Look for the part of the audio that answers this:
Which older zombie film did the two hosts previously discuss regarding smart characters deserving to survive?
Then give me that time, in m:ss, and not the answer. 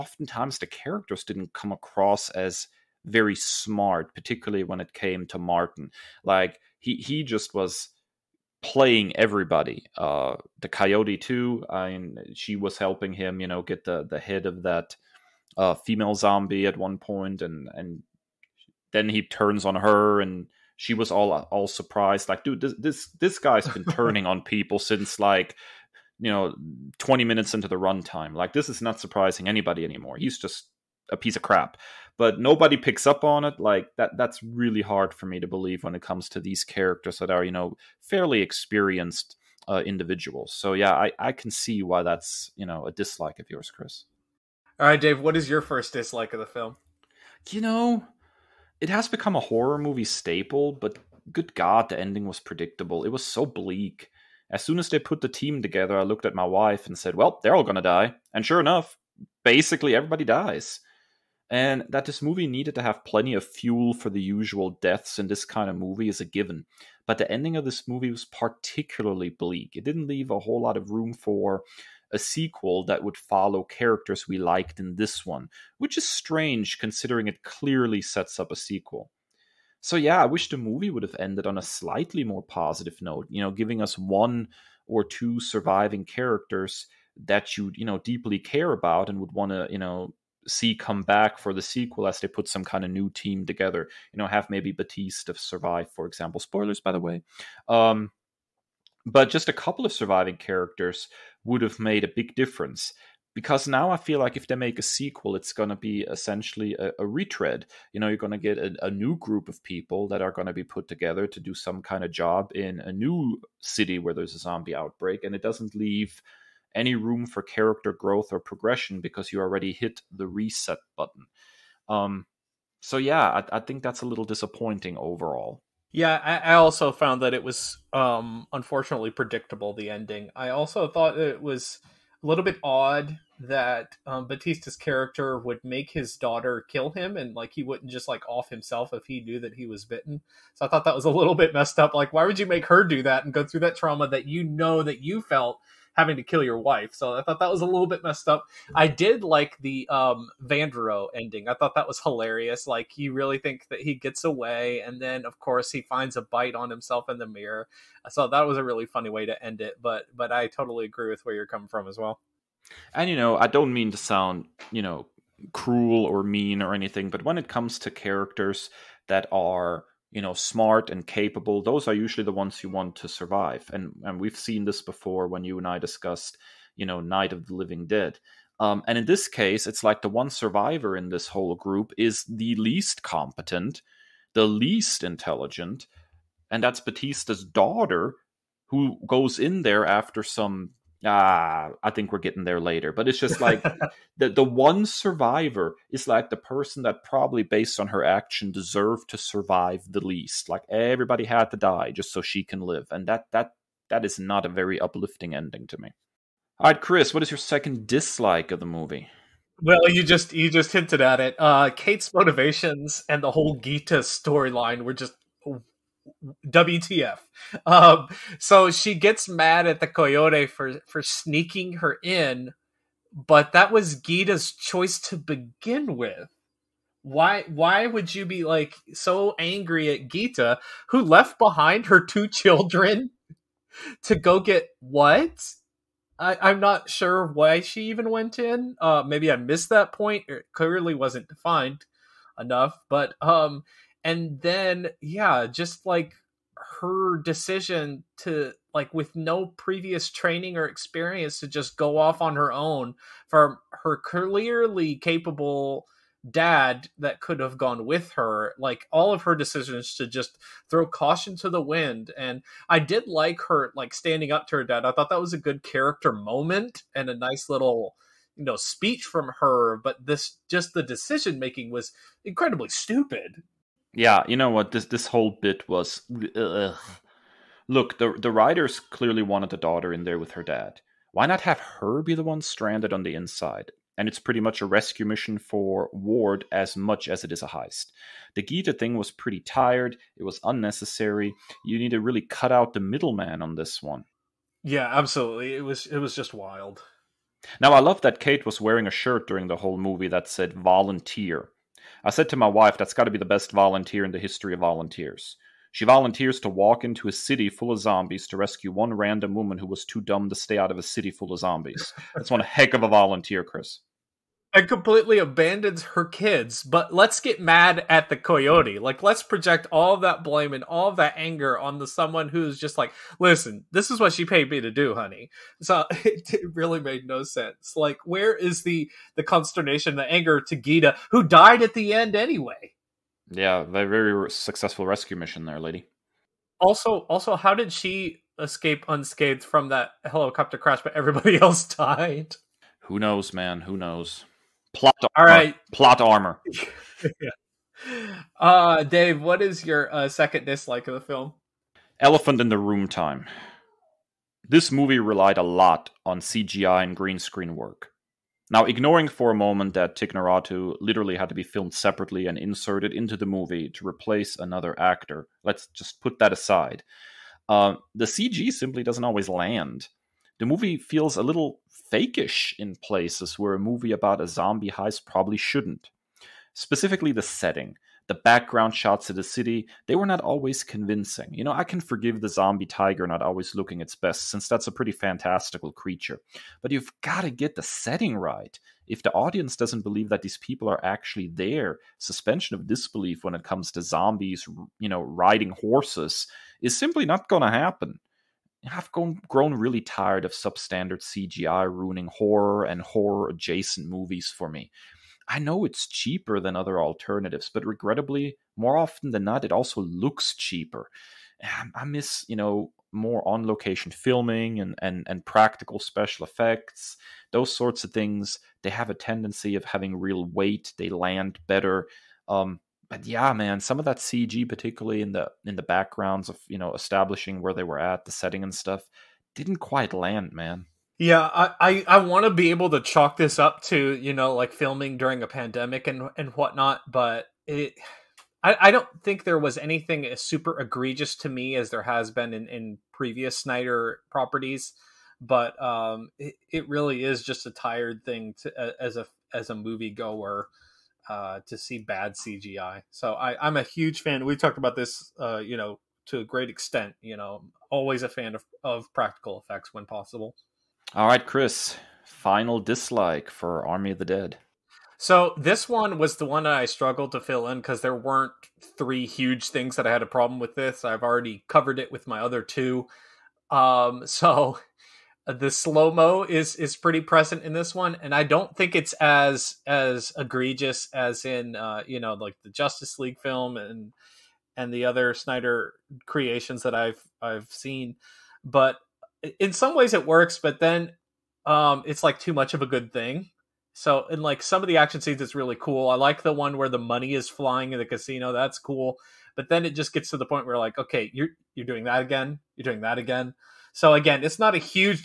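2:56.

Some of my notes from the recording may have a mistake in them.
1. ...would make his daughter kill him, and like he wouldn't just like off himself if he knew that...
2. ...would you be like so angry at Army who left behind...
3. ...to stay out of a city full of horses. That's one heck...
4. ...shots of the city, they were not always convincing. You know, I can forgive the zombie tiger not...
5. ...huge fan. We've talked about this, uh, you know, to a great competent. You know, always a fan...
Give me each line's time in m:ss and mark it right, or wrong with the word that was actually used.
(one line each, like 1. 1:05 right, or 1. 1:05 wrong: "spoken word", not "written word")
1. 2:15 right
2. 3:47 wrong: "Geeta", not "Army"
3. 5:10 wrong: "zombies", not "horses"
4. 6:18 right
5. 7:33 wrong: "extent", not "competent".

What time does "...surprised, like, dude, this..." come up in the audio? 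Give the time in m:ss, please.
0:21.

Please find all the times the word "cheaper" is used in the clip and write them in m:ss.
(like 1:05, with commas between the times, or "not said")
6:45, 6:50.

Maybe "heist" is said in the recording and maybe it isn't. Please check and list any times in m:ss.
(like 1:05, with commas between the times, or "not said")
4:47, 6:14.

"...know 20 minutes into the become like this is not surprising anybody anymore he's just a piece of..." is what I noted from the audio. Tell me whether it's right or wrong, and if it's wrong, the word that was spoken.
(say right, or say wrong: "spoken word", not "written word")
wrong: "runtime", not "become".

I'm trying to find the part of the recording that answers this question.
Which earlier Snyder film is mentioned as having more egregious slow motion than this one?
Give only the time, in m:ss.
8:02.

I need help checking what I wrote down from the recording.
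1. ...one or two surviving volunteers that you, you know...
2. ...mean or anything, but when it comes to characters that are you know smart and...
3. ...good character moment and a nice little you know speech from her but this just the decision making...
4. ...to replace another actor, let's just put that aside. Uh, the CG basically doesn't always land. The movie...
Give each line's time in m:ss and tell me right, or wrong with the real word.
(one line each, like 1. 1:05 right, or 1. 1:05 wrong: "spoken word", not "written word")
1. 1:23 wrong: "characters", not "volunteers"
2. 2:46 right
3. 4:25 right
4. 6:03 wrong: "simply", not "basically".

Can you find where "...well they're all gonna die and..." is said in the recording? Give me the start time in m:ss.
0:57.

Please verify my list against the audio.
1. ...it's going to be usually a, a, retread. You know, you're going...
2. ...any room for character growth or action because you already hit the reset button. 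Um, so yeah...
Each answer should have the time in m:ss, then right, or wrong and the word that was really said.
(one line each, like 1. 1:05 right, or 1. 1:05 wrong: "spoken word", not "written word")
1. 1:45 wrong: "essentially", not "usually"
2. 1:56 wrong: "progression", not "action".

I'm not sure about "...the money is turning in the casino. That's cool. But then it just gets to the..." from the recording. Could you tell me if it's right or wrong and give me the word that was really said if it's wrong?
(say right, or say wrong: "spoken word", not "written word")
wrong: "flying", not "turning".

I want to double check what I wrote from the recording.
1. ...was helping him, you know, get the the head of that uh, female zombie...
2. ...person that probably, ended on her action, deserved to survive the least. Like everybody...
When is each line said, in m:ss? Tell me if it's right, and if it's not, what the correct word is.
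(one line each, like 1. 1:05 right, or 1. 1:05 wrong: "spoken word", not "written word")
1. 0:12 right
2. 3:16 wrong: "based", not "ended".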